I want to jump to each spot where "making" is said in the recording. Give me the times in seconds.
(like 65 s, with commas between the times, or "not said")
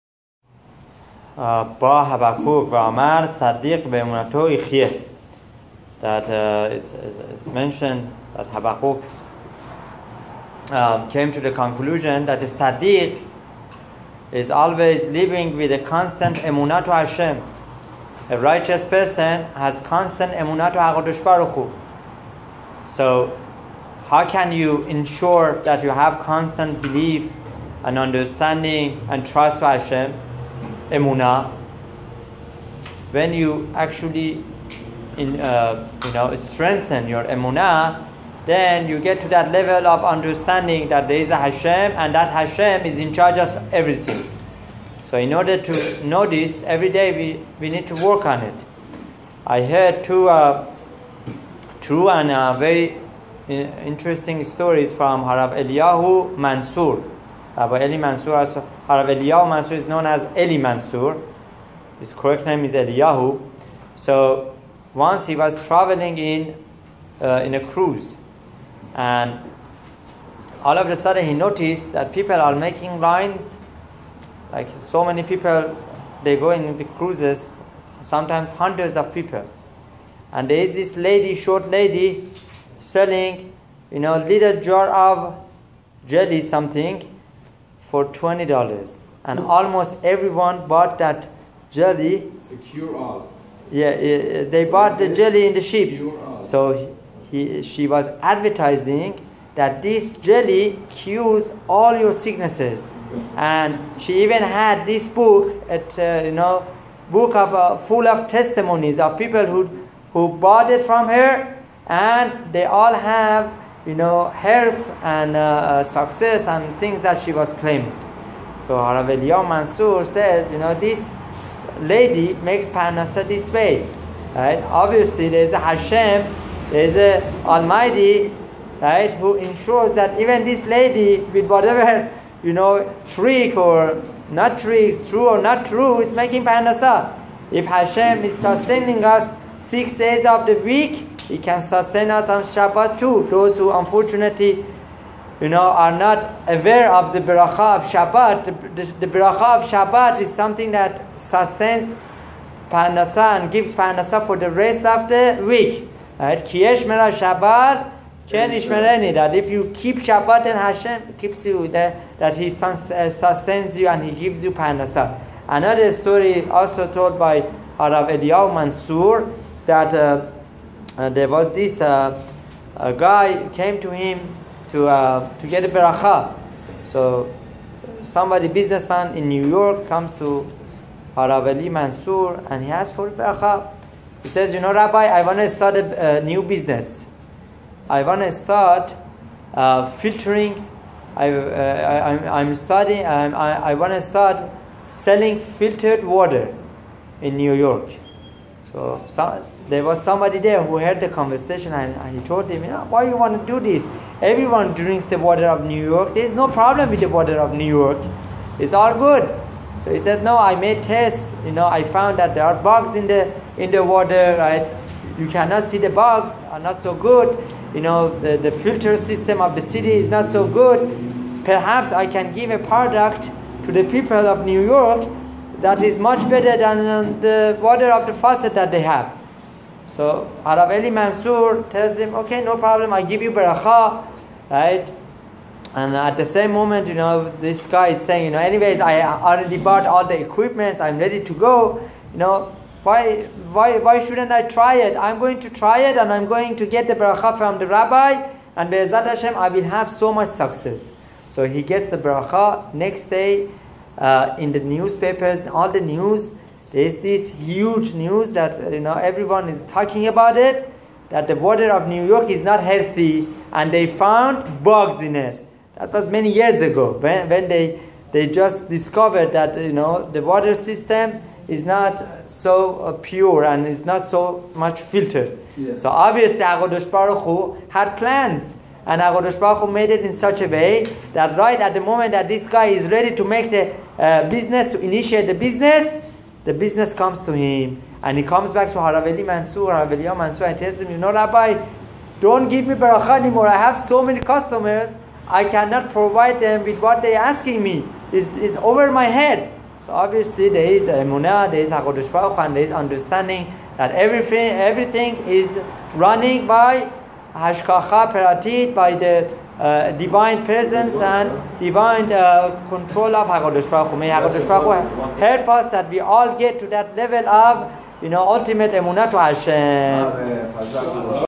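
72 s, 136 s.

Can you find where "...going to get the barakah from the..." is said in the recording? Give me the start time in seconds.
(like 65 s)
246 s.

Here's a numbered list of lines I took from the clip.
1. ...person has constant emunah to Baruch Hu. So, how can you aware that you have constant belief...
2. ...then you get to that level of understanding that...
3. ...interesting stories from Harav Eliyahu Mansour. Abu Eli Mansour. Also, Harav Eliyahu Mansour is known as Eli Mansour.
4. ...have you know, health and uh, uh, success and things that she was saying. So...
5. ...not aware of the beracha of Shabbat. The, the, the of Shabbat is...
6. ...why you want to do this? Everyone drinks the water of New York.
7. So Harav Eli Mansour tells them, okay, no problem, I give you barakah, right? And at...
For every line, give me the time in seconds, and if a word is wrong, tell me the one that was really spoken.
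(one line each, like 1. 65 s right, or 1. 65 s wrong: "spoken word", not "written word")
1. 18 s wrong: "ensure", not "aware"
2. 38 s right
3. 53 s right
4. 112 s wrong: "claiming", not "saying"
5. 145 s right
6. 202 s right
7. 229 s right.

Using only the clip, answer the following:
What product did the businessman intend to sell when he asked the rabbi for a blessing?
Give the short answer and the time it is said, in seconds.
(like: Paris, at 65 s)
Filtered water, at 195 s.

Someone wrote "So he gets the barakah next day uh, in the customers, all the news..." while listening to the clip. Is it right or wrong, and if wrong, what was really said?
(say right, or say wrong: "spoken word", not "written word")
wrong: "newspapers", not "customers".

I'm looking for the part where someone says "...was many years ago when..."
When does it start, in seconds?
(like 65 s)
265 s.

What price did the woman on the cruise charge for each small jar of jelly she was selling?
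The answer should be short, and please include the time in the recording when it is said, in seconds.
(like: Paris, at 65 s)
$20, at 88 s.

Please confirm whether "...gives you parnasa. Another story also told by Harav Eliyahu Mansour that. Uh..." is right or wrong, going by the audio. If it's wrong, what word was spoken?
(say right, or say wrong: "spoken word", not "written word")
right.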